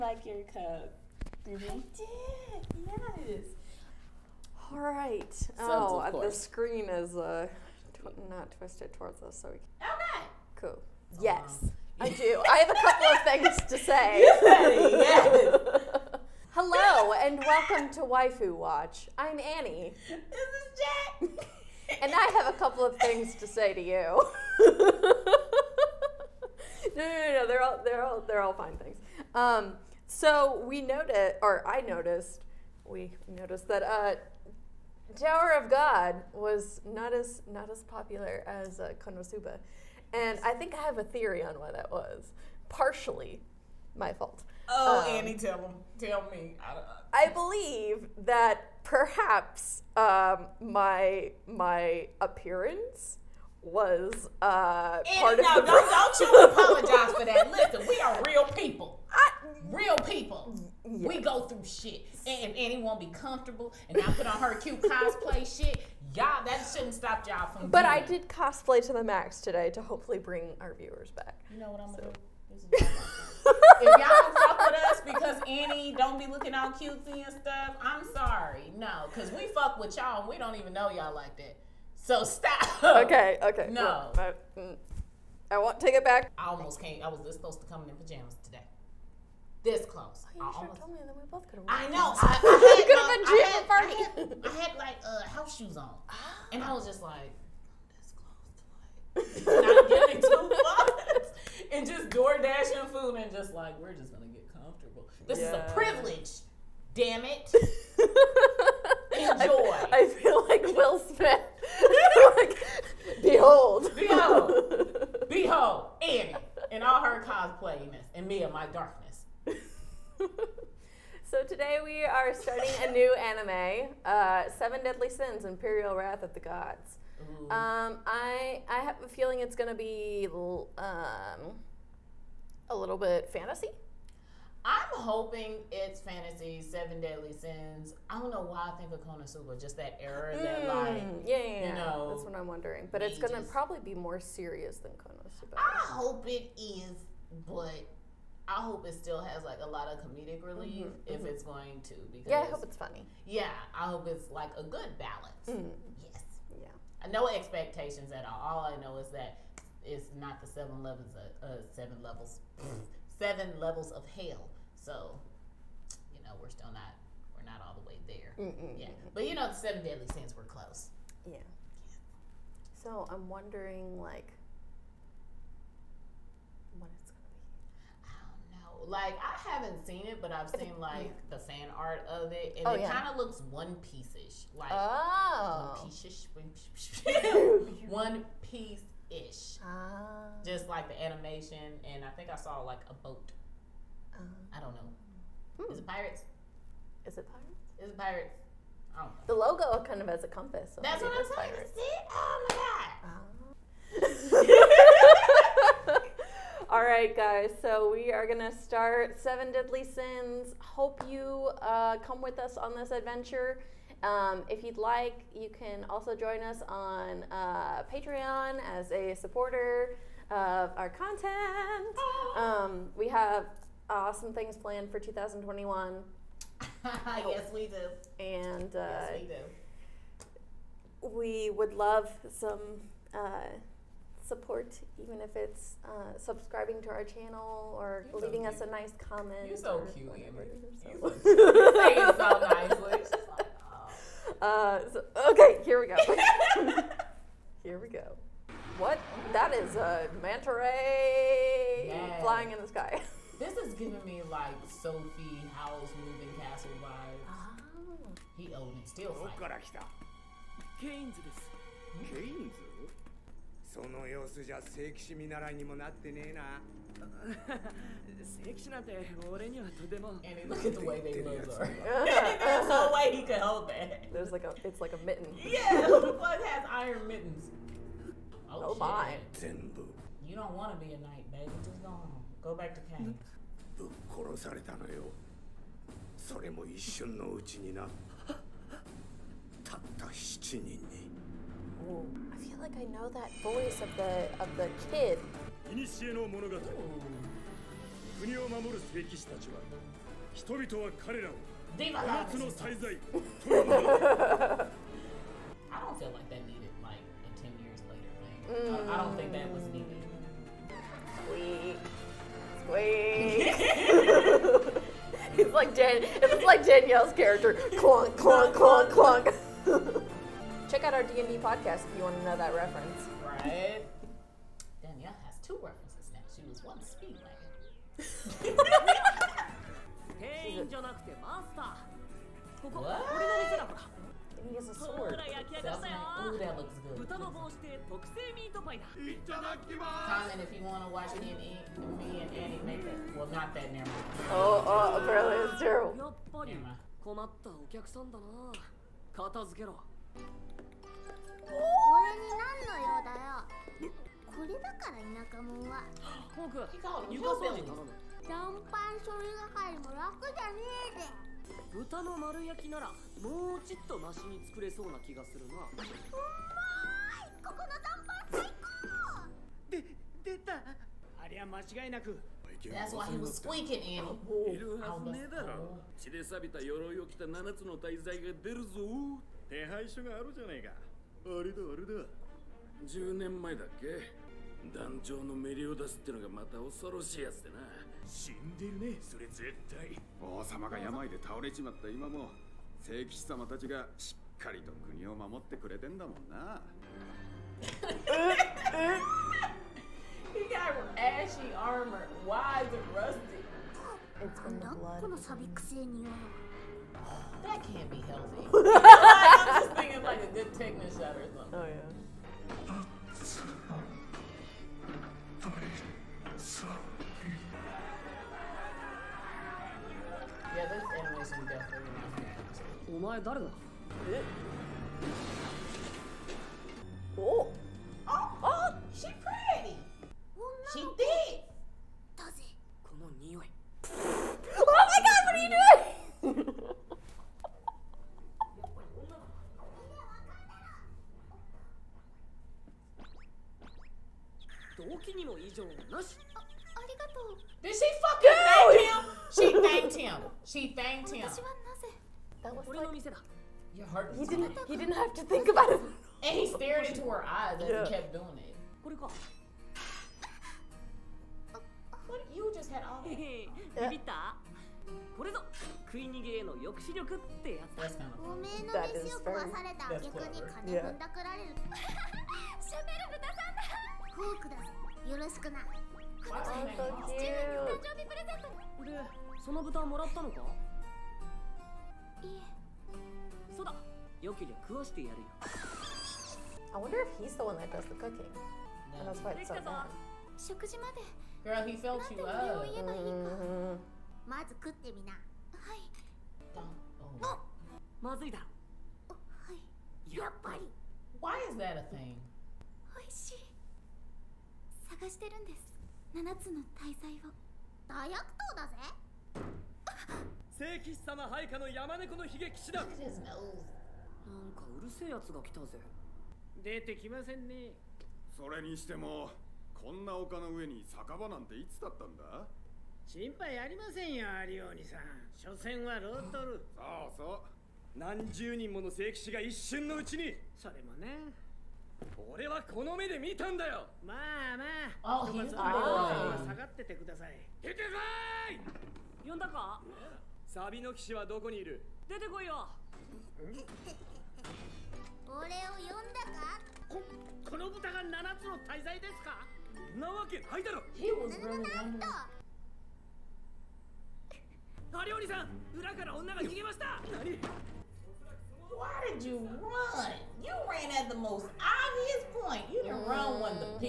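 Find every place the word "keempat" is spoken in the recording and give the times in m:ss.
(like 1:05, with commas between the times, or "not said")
not said.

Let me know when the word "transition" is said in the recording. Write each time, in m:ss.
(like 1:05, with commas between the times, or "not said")
not said.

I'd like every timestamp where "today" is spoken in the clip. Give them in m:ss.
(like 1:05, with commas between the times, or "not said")
1:09, 1:28, 2:01.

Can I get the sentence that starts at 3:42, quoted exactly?
Um, we have awesome things planned for 2021.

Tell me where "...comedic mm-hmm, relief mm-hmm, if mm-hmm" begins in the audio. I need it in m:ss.
2:29.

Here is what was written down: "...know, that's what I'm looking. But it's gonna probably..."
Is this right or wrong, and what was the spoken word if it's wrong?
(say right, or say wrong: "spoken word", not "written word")
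wrong: "wondering", not "looking".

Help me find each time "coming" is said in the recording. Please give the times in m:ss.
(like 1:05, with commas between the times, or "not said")
1:27.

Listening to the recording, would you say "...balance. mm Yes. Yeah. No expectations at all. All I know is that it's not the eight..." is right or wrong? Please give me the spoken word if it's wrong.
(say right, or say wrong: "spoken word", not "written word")
wrong: "seven", not "eight".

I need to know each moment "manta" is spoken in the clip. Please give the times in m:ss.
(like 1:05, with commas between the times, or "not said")
4:10.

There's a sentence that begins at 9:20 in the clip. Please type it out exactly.
You ran at the most obvious point.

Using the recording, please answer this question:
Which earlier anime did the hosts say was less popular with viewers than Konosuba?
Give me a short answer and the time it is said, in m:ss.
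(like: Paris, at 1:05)
Tower of God, at 0:35.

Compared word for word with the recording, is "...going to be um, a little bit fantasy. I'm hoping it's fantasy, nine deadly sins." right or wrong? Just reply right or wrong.
wrong.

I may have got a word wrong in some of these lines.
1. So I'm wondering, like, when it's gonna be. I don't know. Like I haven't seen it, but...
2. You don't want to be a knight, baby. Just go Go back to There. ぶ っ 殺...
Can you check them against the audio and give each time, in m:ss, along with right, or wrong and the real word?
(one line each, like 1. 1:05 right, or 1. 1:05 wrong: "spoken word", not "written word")
1. 2:52 right
2. 4:40 wrong: "Kang", not "There".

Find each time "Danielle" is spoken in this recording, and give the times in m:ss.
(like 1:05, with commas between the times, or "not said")
5:16, 5:24.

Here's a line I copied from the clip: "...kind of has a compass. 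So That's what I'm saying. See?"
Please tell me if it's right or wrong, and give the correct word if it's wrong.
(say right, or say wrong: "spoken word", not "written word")
right.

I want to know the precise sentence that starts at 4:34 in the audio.
There's like a, it's like a mitten.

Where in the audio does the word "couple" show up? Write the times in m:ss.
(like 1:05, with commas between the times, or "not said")
0:13, 0:22.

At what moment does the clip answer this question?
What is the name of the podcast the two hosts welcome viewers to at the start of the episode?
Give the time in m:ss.
0:18.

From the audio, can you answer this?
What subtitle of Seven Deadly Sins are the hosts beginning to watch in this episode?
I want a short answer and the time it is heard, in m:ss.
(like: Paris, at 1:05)
Imperial Wrath of the Gods, at 2:05.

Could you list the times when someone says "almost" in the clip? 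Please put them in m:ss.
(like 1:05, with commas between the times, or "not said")
1:26, 1:30.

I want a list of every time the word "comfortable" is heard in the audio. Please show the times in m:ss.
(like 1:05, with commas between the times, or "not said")
1:03, 1:44.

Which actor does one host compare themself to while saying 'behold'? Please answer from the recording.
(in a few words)
Will Smith.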